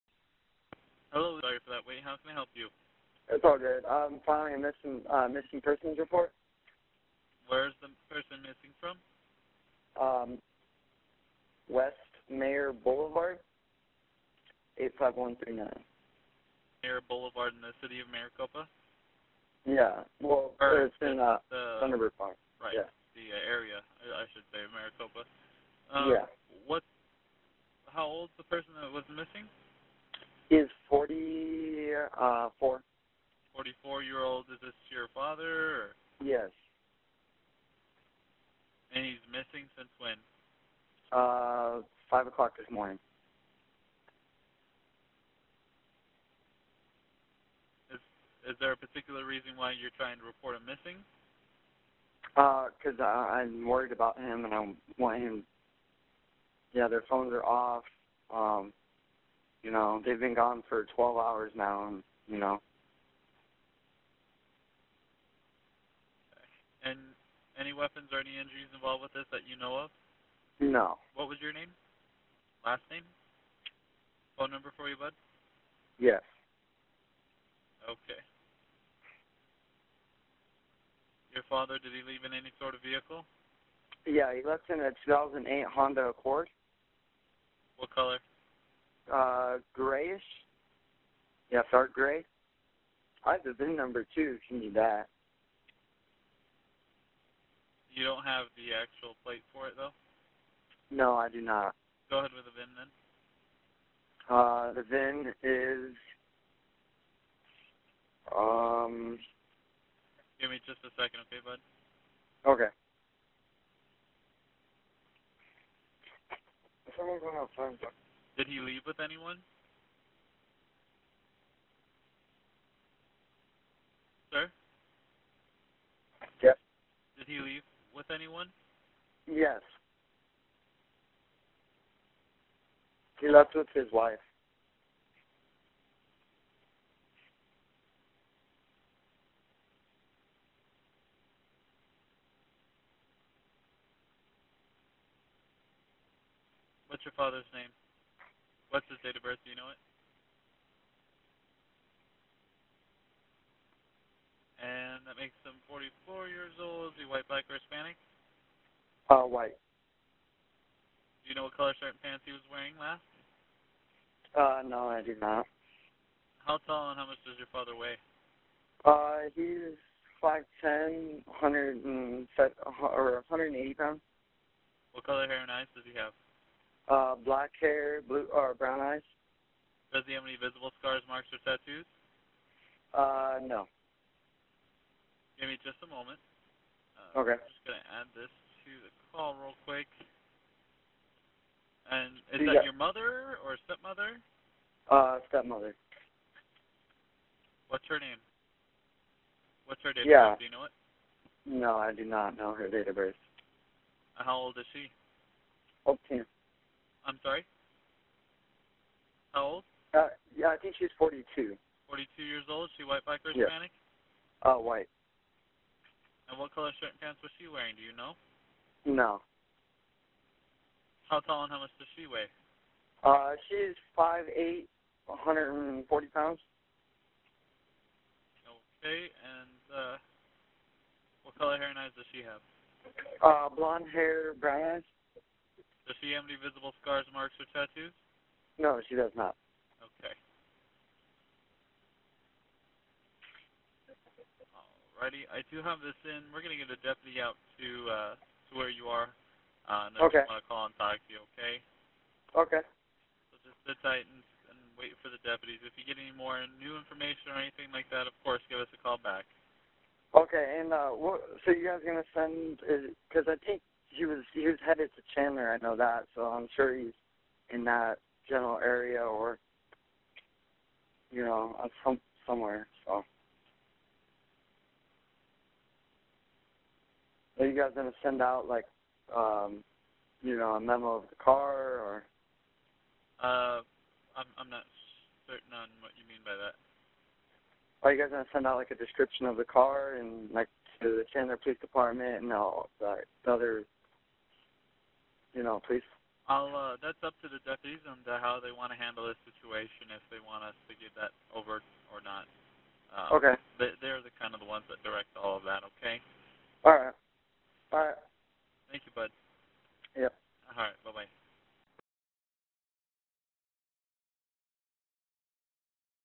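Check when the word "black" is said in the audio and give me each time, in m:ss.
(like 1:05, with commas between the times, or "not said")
2:57, 3:33.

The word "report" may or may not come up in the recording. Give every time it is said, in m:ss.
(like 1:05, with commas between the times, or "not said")
0:05, 0:50.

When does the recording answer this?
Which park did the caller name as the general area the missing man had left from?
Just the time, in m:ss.
0:21.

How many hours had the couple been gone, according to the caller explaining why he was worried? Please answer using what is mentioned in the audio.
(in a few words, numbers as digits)
12.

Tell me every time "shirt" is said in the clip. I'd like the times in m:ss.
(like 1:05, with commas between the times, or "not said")
2:41, 3:36.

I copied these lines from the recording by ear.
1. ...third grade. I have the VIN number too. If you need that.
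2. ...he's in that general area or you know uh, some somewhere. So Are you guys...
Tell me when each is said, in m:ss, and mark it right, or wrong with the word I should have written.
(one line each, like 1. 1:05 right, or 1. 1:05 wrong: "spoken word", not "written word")
1. 1:31 right
2. 4:26 right.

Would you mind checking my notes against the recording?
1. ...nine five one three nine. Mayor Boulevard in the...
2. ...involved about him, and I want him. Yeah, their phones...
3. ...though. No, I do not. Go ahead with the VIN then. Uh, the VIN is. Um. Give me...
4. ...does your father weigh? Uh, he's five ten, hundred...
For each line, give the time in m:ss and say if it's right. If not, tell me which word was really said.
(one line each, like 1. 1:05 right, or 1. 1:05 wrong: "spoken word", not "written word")
1. 0:14 wrong: "eight", not "nine"
2. 0:53 wrong: "worried", not "involved"
3. 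1:39 right
4. 2:47 right.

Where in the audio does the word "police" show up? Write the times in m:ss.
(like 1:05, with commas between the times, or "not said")
4:51, 4:55.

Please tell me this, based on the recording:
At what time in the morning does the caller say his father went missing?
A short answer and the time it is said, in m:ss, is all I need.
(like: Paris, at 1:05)
5 o'clock, at 0:42.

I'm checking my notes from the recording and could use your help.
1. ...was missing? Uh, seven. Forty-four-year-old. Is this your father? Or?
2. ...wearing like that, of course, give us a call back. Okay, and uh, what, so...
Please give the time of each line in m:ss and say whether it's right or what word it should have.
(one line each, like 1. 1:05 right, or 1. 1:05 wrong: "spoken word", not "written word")
1. 0:28 wrong: "four", not "seven"
2. 4:17 wrong: "anything", not "wearing".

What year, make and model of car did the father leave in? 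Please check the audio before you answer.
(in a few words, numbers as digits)
2008 Honda Accord.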